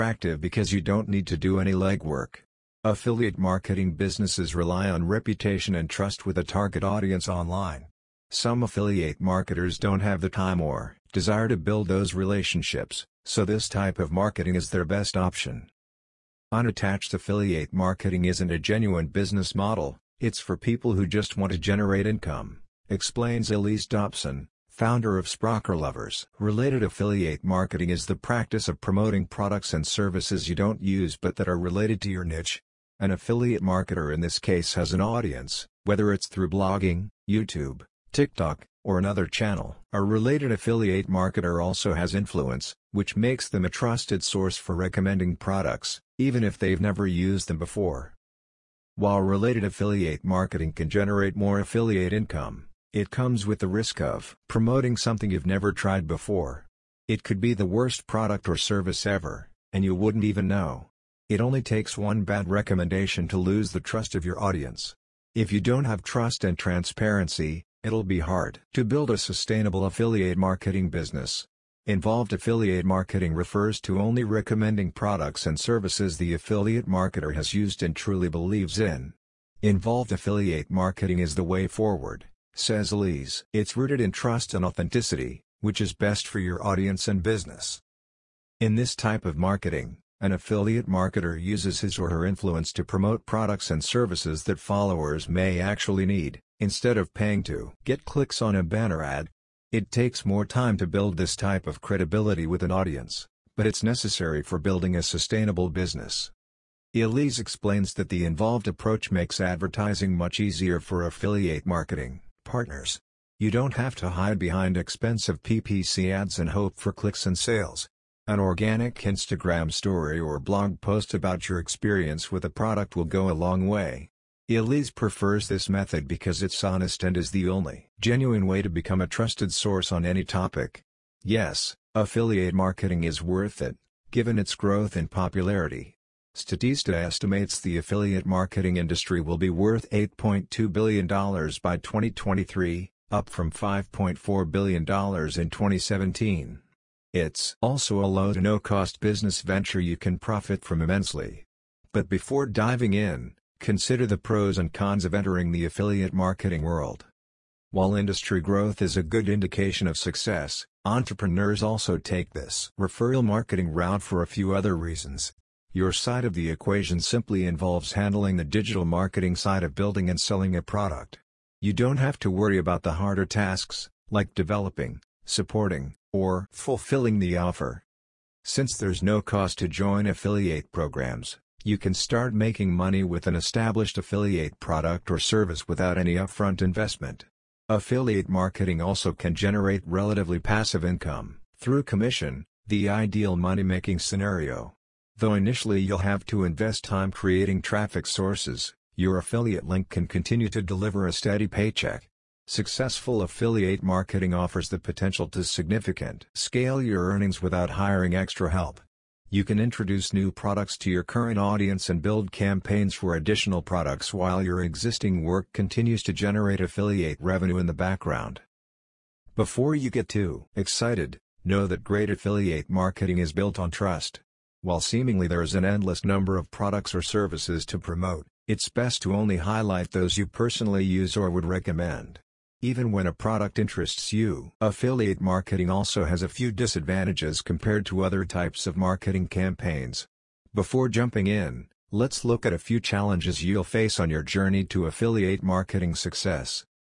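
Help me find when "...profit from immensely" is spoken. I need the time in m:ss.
2:30.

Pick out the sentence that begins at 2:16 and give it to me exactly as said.
Statista estimates the affiliate marketing industry will be worth $8.2 billion by 2023, up from $5.4 billion in 2017.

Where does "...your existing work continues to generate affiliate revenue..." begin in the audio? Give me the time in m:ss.
3:34.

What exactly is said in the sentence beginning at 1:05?
If you don't have trust and transparency, it'll be hard to build a sustainable affiliate marketing business.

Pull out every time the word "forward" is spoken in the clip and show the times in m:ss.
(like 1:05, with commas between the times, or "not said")
1:21.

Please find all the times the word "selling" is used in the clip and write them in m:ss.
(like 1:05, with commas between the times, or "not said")
2:50.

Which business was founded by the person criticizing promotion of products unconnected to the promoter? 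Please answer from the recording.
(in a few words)
Sprocker Lovers.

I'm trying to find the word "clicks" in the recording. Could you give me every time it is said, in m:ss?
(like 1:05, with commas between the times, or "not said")
1:38, 1:56.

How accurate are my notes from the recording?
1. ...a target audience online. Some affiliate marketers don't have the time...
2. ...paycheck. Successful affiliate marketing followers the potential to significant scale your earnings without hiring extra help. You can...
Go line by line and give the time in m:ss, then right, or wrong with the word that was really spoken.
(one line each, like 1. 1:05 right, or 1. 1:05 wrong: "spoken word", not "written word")
1. 0:06 right
2. 3:21 wrong: "offers", not "followers".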